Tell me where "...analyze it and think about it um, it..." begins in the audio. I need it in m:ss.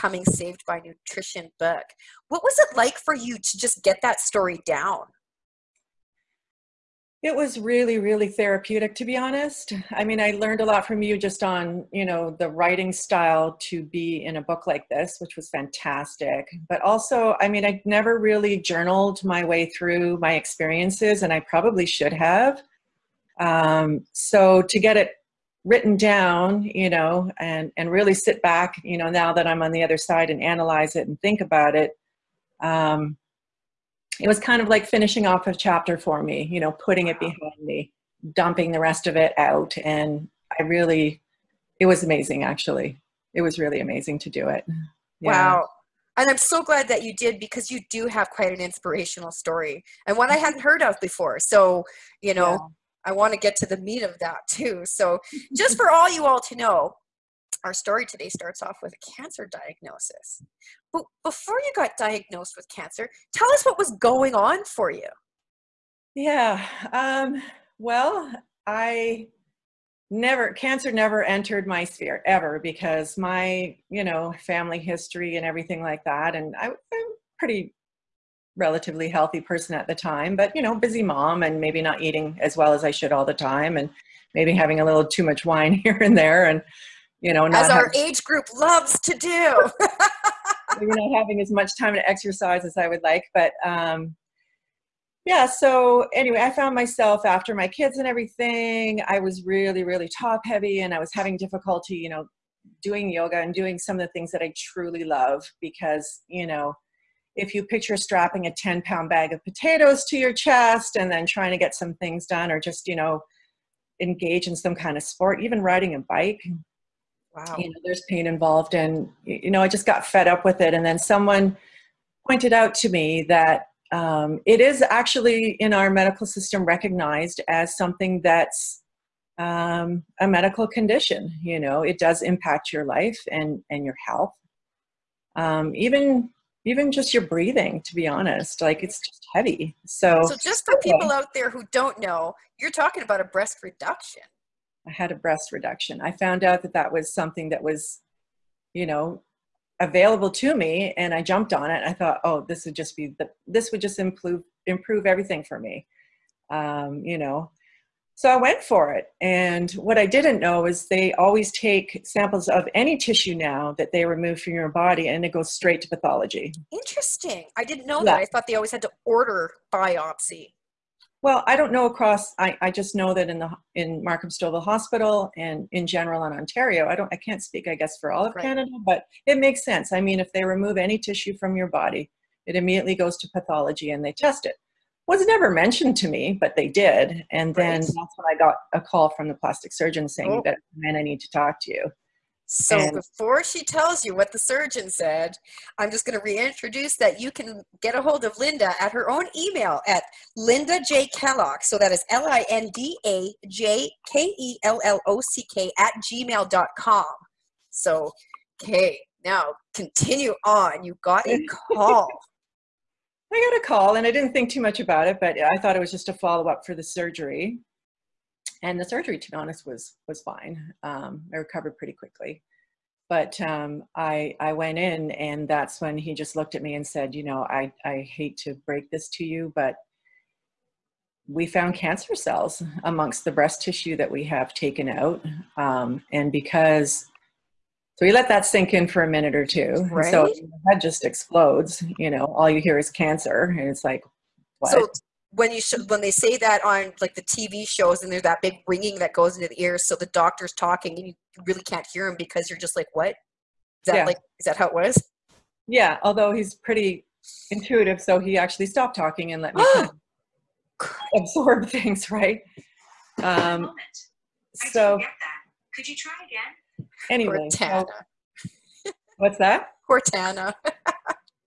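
0:30.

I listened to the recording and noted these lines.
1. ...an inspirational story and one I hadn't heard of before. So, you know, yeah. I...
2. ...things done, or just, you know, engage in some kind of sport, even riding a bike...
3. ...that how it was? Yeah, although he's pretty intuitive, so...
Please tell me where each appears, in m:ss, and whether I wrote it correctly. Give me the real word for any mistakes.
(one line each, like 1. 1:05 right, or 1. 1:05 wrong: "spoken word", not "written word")
1. 0:48 right
2. 1:51 right
3. 4:14 right.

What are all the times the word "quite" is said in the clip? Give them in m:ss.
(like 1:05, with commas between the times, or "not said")
0:48.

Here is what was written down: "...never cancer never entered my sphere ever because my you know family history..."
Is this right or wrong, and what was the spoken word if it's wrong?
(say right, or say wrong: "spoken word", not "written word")
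right.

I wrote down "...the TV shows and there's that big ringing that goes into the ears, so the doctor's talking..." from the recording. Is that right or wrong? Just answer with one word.
right.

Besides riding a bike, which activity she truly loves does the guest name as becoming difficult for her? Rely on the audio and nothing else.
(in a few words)
Yoga.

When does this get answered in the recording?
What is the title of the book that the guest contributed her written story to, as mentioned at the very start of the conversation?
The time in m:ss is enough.
0:00.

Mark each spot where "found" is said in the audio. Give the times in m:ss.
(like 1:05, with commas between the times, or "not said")
1:36, 2:26, 3:51.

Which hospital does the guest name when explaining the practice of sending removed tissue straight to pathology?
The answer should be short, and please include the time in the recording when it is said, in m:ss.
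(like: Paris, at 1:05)
Markham Stouffville Hospital, at 2:54.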